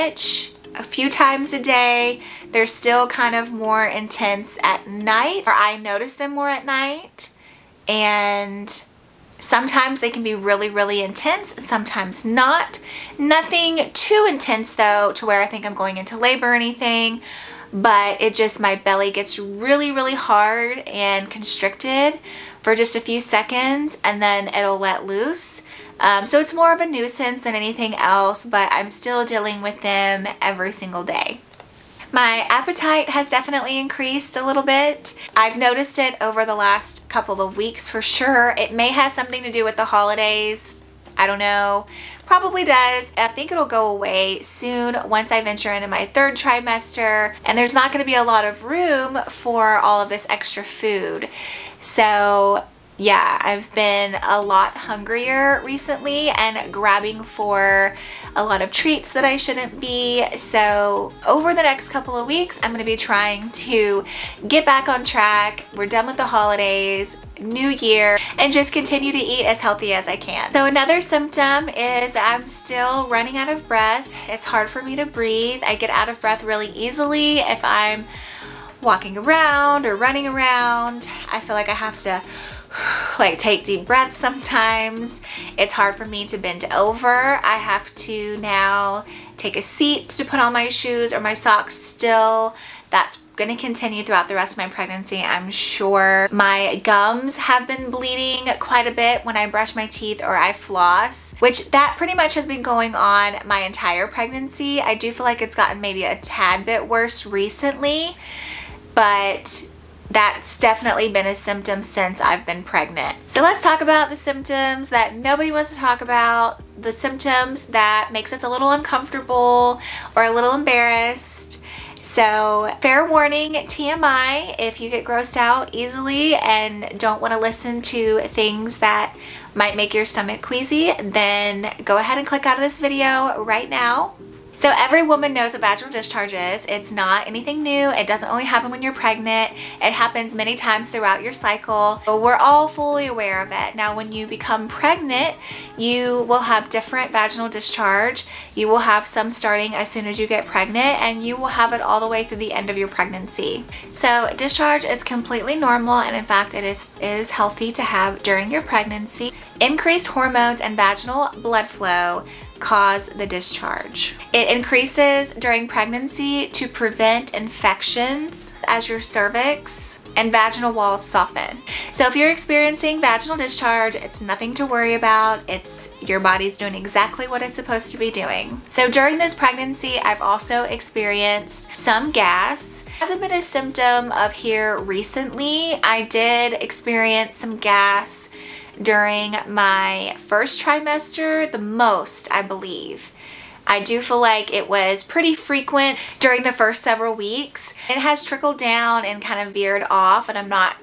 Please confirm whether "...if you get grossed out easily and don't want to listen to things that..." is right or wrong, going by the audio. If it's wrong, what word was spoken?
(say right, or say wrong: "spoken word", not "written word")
right.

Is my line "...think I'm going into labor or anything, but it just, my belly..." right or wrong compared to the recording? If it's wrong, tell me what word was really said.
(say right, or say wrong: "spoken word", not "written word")
right.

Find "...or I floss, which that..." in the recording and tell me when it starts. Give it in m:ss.
1:40.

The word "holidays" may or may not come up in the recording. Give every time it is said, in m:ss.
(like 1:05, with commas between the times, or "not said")
0:39, 1:06.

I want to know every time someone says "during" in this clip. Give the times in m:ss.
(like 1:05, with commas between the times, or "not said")
2:38, 2:45, 2:58, 3:08, 3:16.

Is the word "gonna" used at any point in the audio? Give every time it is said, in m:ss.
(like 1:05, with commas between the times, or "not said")
1:02.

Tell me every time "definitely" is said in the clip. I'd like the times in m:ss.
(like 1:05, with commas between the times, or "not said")
0:33, 1:50.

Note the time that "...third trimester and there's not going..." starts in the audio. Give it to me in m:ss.
0:46.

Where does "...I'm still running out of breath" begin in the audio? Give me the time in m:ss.
1:12.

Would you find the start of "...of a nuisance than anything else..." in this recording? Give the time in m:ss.
0:26.